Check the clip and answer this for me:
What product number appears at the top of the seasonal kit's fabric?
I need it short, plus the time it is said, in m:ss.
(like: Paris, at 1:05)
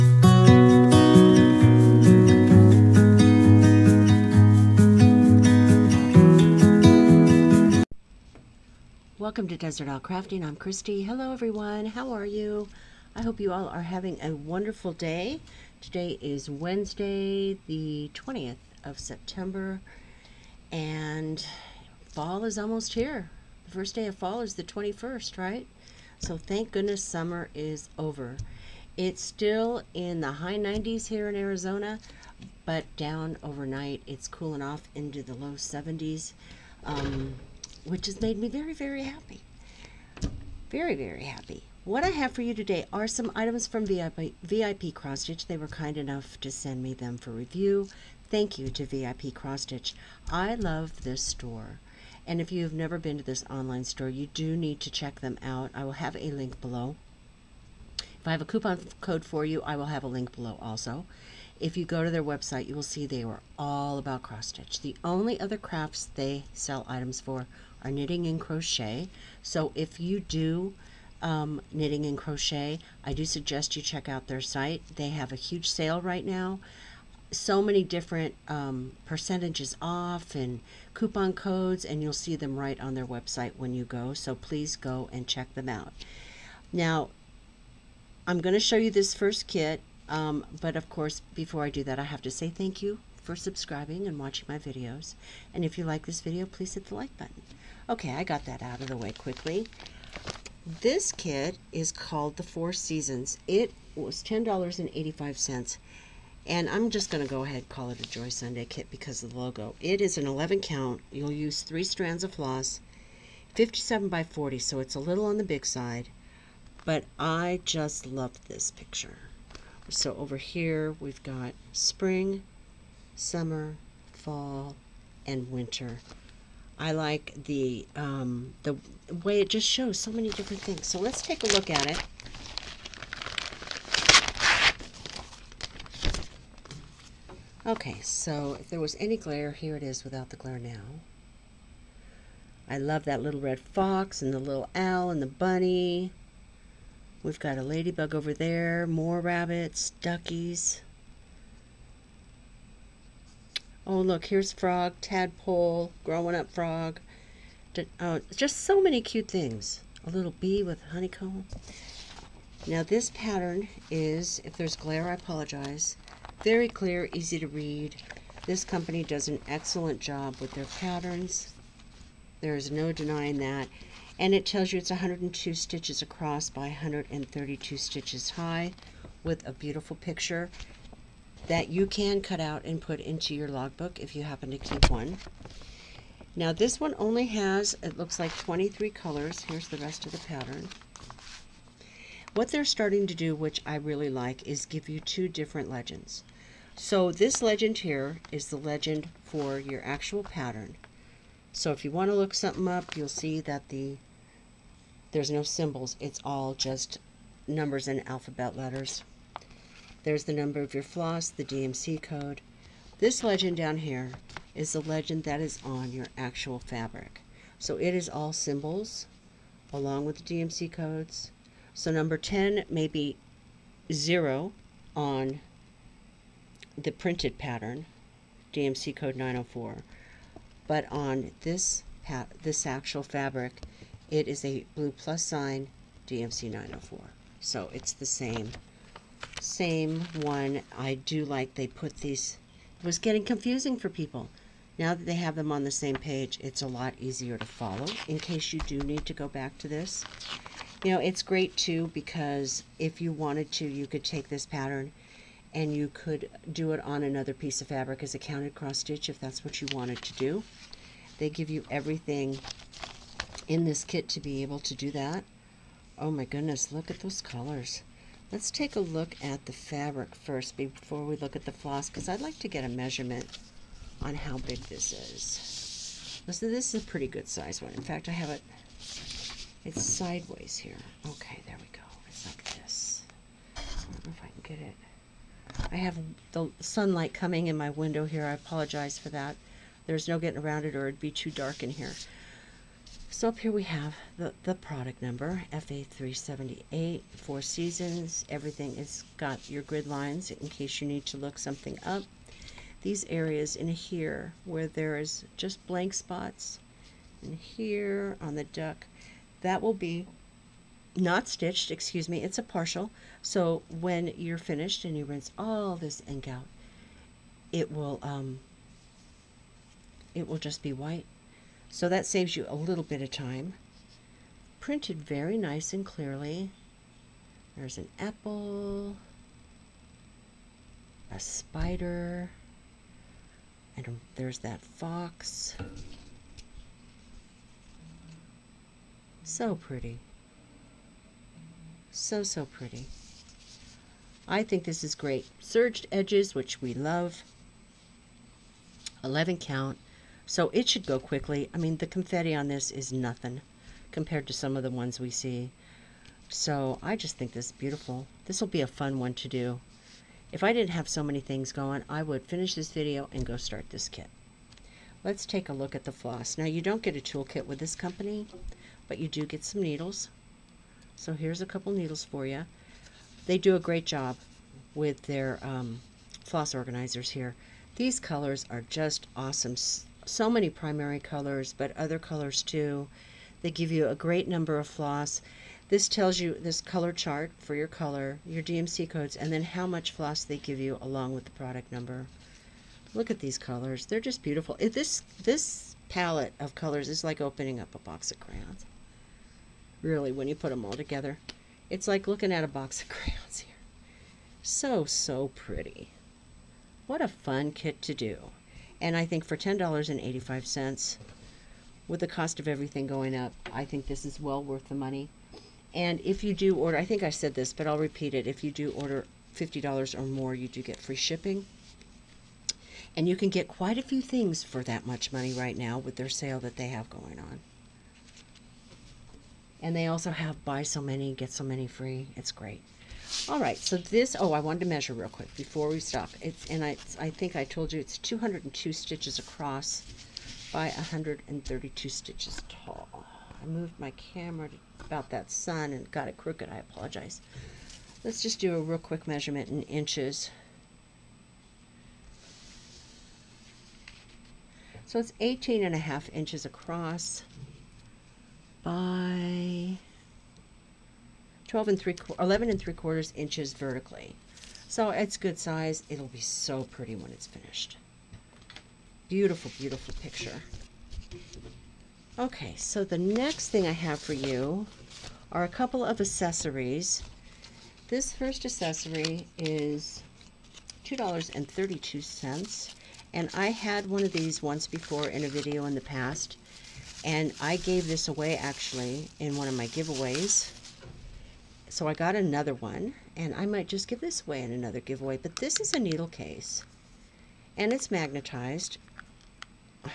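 FA378, at 4:55.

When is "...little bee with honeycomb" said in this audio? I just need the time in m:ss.
2:40.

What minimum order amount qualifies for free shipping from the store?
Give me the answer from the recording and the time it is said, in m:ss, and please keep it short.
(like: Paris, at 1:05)
$50, at 6:59.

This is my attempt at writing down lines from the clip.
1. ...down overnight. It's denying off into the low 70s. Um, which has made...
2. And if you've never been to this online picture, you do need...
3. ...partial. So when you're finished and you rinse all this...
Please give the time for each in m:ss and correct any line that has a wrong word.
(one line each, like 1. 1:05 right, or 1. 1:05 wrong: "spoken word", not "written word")
1. 0:32 wrong: "cooling", not "denying"
2. 0:52 wrong: "store", not "picture"
3. 5:12 right.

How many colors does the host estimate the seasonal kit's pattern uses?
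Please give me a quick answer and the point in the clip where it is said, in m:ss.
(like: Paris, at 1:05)
23, at 3:08.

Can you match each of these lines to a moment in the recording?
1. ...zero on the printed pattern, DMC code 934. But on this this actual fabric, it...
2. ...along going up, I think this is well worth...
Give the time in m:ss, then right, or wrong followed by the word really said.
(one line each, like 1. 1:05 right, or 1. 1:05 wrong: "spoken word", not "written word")
1. 3:43 wrong: "904", not "934"
2. 6:52 wrong: "everything", not "along".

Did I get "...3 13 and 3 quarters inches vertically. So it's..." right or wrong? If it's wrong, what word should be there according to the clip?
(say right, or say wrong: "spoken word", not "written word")
wrong: "11", not "13".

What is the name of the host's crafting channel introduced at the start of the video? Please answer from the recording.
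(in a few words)
Desert Owl Crafting.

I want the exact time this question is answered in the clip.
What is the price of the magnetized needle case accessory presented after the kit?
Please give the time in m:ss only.
8:00.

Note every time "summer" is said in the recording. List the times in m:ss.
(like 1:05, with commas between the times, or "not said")
0:27, 2:03.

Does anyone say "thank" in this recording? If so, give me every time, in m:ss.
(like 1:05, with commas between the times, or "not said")
0:26, 0:48, 1:32.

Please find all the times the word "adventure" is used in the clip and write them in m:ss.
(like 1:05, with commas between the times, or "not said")
not said.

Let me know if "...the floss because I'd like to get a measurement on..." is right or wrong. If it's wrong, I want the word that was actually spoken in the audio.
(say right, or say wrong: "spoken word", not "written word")
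right.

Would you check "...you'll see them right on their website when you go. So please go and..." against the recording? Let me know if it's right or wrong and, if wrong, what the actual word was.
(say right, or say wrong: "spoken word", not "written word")
right.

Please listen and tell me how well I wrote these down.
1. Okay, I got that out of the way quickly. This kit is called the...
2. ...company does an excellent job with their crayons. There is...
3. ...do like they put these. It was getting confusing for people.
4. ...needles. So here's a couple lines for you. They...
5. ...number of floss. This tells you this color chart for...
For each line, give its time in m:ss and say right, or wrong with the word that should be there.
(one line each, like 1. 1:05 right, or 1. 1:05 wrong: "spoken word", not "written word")
1. 1:37 right
2. 2:48 wrong: "patterns", not "crayons"
3. 4:00 right
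4. 6:09 wrong: "needles", not "lines"
5. 6:24 right.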